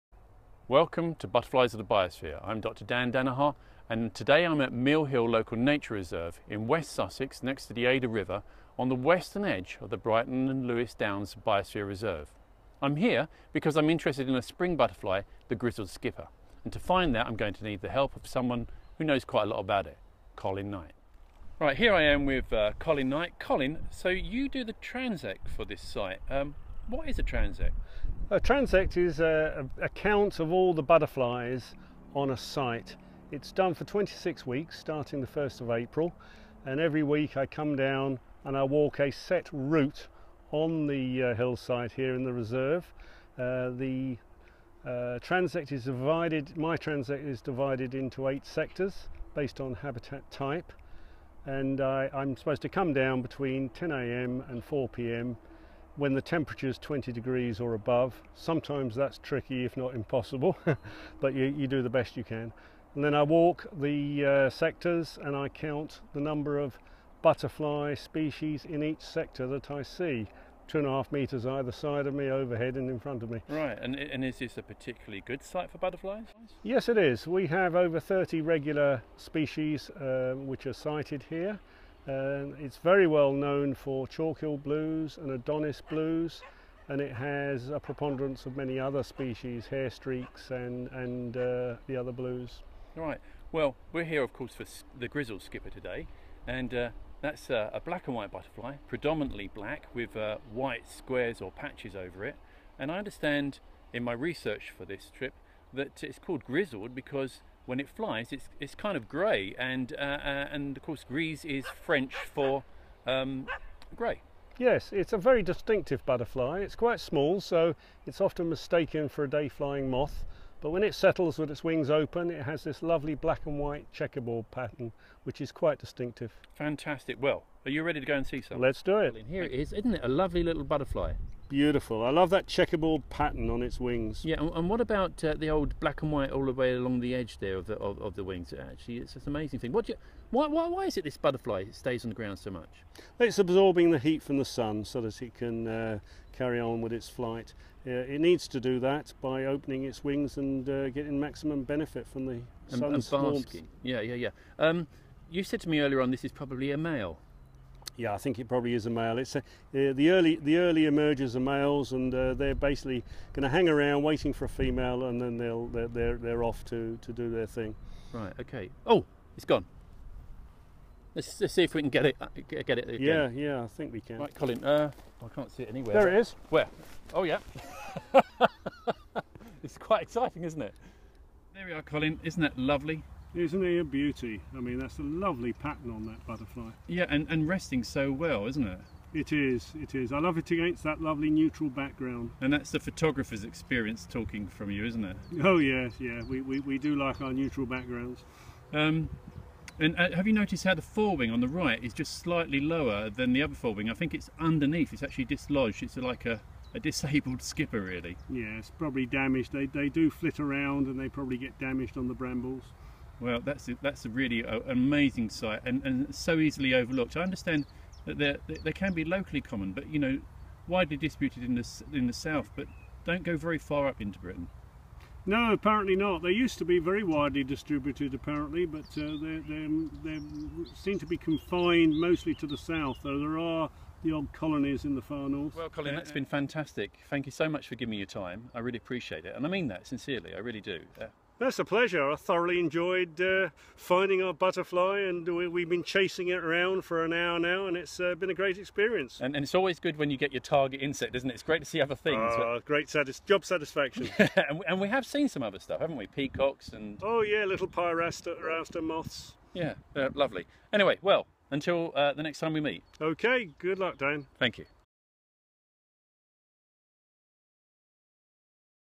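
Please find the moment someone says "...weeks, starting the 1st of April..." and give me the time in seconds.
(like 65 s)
34 s.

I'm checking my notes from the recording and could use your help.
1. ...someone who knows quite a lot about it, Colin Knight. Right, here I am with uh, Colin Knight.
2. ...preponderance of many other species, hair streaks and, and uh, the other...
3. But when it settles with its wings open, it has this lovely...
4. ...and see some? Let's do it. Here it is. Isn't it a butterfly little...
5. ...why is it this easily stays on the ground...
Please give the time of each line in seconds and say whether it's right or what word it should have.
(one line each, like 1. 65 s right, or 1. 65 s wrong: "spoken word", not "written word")
1. 18 s right
2. 87 s right
3. 120 s right
4. 128 s wrong: "lovely", not "butterfly"
5. 140 s wrong: "butterfly", not "easily".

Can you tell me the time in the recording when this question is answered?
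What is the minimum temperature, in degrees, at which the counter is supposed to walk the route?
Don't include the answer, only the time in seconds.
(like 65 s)
56 s.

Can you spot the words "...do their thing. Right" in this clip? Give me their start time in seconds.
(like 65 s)
167 s.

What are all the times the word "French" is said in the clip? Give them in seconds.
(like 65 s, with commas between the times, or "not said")
111 s.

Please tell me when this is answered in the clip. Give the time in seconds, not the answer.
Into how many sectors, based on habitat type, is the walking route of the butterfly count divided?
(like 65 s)
48 s.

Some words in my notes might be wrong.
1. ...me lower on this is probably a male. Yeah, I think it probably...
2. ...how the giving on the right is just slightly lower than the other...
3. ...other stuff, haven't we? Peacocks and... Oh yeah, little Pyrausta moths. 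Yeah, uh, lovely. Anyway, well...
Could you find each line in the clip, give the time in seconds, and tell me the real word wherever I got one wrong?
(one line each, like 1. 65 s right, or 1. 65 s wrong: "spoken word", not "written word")
1. 155 s wrong: "earlier", not "lower"
2. 200 s wrong: "forewing", not "giving"
3. 255 s right.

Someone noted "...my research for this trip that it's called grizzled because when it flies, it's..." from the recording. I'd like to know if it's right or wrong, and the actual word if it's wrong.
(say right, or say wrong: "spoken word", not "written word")
right.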